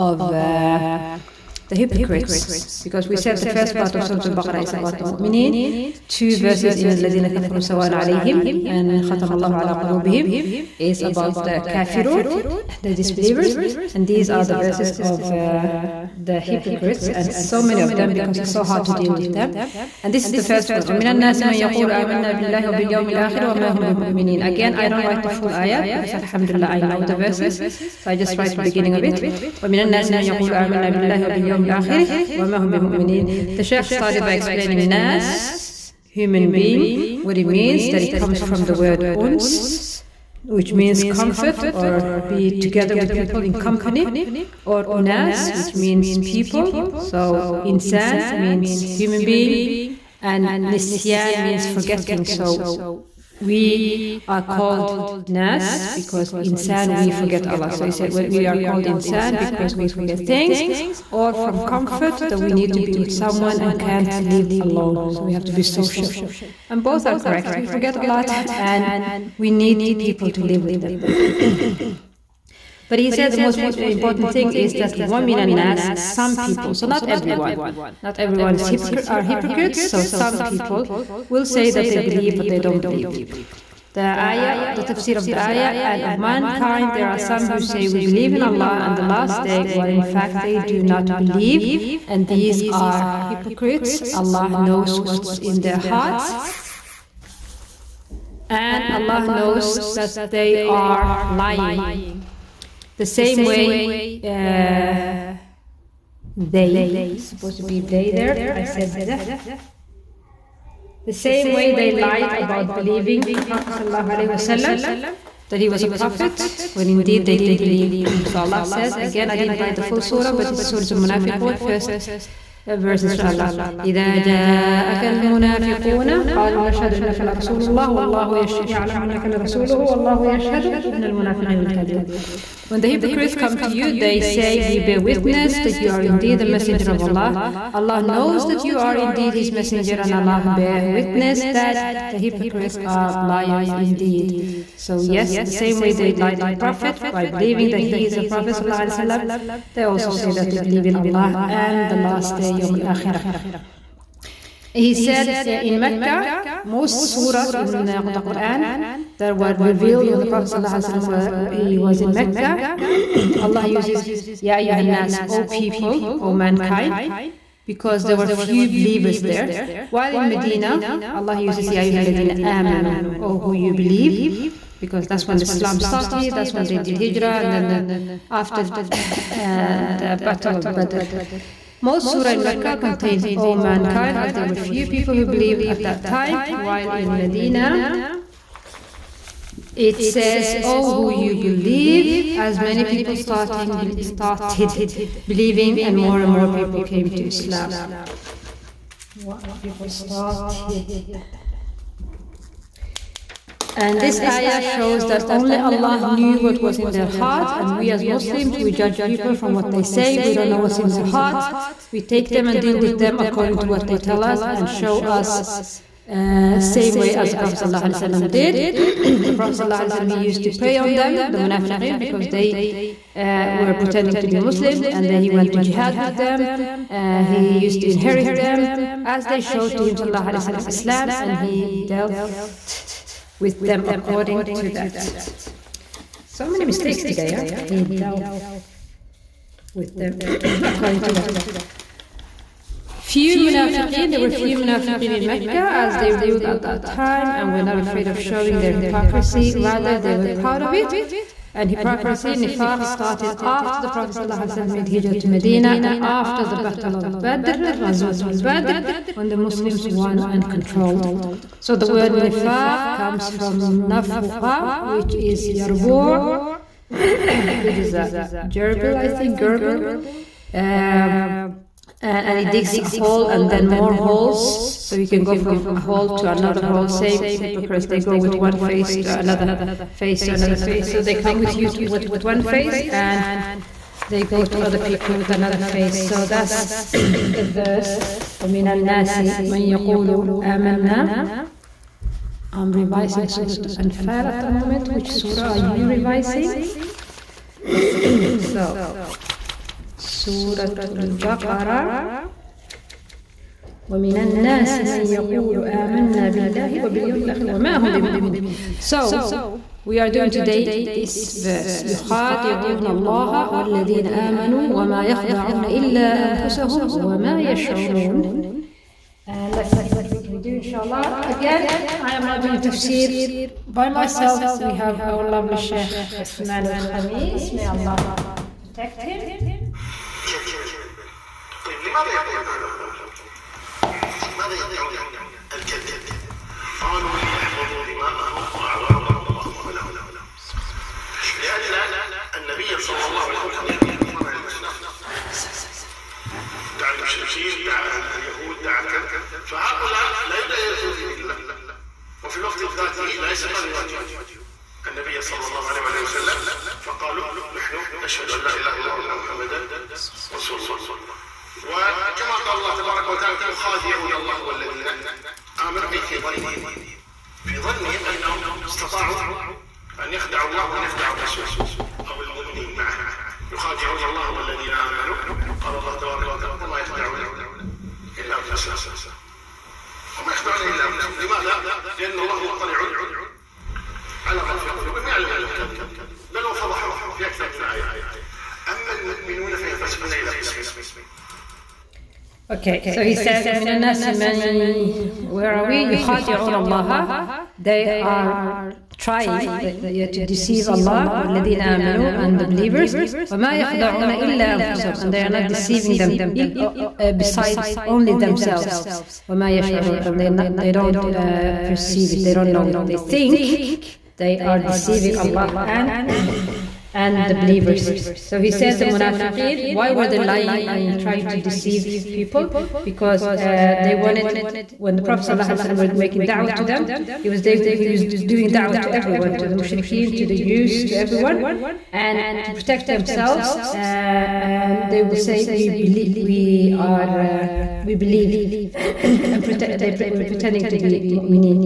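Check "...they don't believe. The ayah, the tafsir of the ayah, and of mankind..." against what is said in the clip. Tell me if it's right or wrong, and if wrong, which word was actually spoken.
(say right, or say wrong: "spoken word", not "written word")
right.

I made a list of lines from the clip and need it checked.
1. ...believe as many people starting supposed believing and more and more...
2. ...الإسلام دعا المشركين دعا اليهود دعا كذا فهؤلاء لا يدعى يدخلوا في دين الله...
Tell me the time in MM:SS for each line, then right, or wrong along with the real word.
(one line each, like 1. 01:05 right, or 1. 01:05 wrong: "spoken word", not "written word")
1. 03:11 wrong: "started", not "supposed"
2. 05:44 right.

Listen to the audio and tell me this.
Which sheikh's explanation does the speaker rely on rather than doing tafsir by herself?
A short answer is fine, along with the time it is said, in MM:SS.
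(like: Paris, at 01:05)
Sheikh Uthman al-Khamis, at 05:25.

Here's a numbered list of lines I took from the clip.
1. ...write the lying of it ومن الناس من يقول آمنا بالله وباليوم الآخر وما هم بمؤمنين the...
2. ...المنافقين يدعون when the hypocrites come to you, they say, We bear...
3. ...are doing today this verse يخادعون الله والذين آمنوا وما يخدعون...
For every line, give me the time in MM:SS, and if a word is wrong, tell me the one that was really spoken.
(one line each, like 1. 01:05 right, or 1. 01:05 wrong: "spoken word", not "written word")
1. 00:28 wrong: "beginning", not "lying"
2. 02:11 wrong: "لكاذبون", not "يدعون"
3. 05:09 right.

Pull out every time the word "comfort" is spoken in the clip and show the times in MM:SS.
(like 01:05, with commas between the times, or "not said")
00:41, 01:01.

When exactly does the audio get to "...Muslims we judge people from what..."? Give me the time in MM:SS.
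03:28.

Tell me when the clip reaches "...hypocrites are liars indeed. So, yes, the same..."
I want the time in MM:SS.
02:22.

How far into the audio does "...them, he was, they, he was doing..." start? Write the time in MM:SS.
07:06.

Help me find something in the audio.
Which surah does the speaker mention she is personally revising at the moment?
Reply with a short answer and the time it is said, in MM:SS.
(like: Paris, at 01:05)
Surah Anfal, at 04:53.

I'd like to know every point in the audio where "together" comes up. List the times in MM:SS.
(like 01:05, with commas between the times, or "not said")
00:42.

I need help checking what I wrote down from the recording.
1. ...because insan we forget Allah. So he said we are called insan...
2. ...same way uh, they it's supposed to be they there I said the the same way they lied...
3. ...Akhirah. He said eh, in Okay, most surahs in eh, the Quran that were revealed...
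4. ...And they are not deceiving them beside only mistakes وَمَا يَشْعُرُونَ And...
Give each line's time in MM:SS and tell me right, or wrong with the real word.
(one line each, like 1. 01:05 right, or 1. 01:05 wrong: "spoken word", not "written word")
1. 00:55 right
2. 01:43 right
3. 02:32 wrong: "Mecca", not "Okay"
4. 06:44 wrong: "themselves", not "mistakes".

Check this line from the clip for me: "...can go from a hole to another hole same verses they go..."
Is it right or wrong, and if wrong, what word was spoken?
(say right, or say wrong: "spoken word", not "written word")
wrong: "hypocrites", not "verses".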